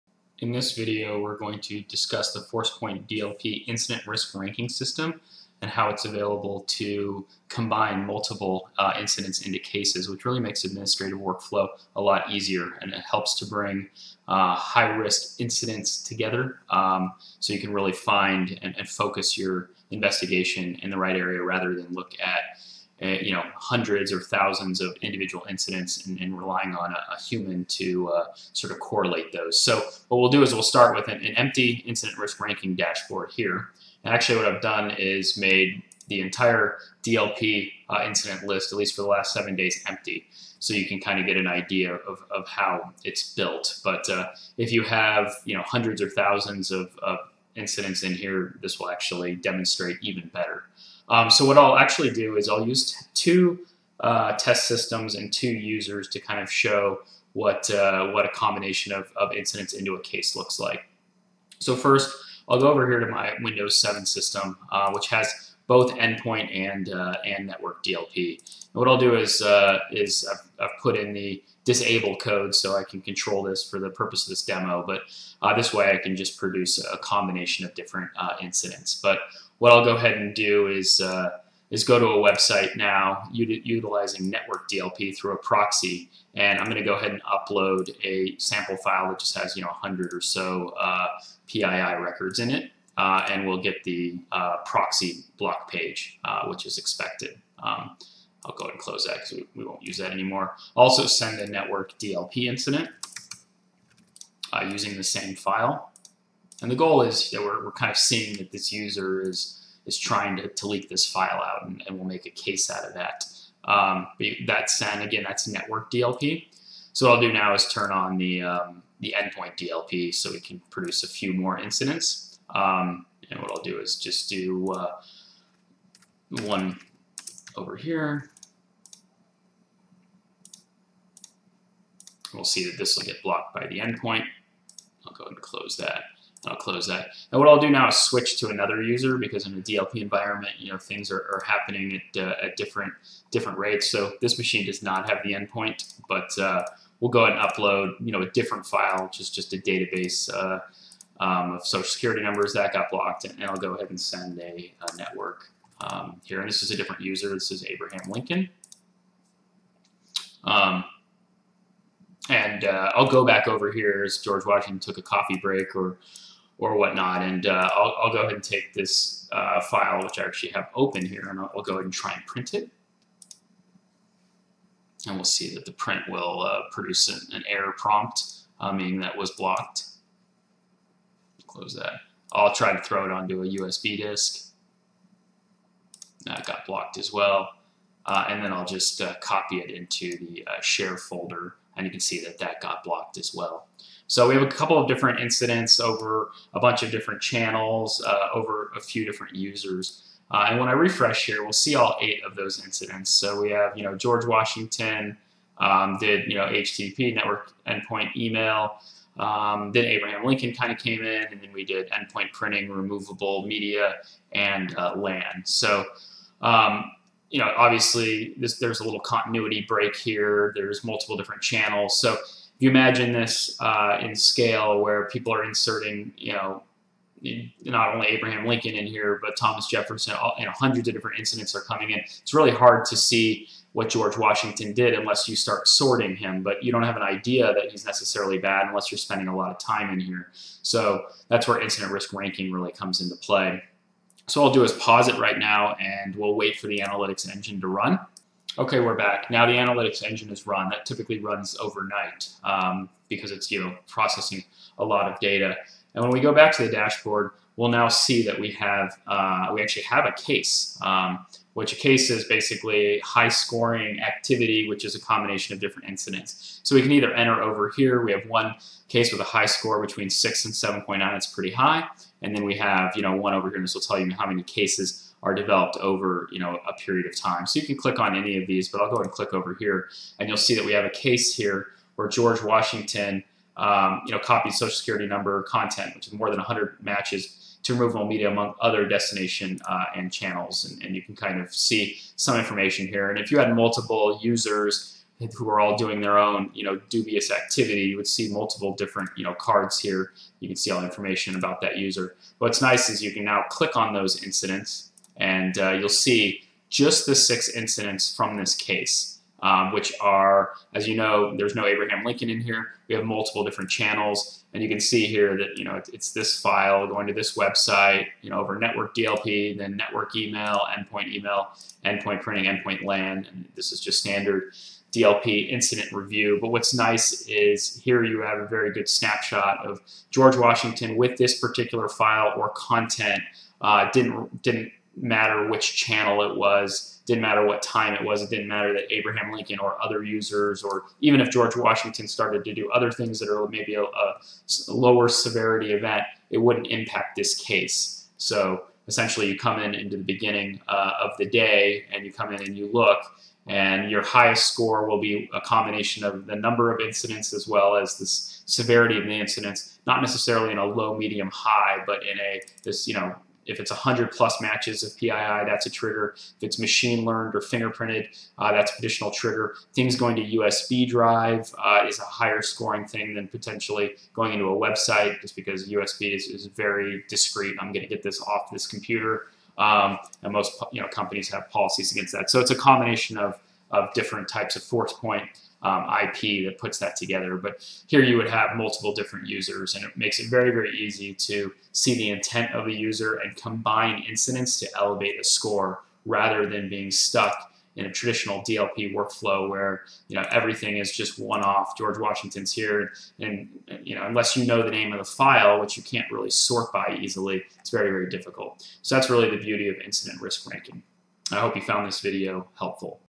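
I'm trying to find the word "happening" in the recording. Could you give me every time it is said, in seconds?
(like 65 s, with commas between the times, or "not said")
141 s.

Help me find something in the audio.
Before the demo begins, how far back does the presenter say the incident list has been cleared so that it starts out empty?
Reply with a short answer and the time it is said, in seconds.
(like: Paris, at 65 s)
last seven days, at 39 s.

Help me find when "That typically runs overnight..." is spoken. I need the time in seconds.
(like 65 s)
250 s.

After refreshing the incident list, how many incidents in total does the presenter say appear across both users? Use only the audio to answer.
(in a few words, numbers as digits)
8.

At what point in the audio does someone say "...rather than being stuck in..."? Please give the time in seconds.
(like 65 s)
396 s.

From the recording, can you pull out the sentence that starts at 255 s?
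And when we go back to the dashboard, we'll now see that we have uh, we actually have a case.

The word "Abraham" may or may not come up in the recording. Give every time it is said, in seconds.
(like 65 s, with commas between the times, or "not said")
157 s, 209 s, 228 s, 311 s, 338 s.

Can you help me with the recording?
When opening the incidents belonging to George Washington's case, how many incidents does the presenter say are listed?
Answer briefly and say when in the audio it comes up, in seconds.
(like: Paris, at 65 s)
6, at 307 s.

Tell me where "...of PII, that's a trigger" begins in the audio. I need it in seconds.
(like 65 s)
364 s.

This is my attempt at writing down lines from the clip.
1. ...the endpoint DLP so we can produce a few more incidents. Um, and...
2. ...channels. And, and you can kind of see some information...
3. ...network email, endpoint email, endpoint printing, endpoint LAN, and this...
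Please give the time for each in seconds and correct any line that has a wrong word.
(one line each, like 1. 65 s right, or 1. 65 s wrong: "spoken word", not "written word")
1. 118 s right
2. 290 s right
3. 319 s right.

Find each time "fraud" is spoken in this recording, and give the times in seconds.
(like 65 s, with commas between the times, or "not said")
not said.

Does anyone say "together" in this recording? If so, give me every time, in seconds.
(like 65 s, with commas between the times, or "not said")
16 s, 386 s.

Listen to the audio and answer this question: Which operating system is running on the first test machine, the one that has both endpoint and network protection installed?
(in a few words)
Windows 7.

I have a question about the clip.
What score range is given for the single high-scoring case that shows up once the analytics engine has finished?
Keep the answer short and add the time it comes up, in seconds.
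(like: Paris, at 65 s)
6 to 7.9, at 269 s.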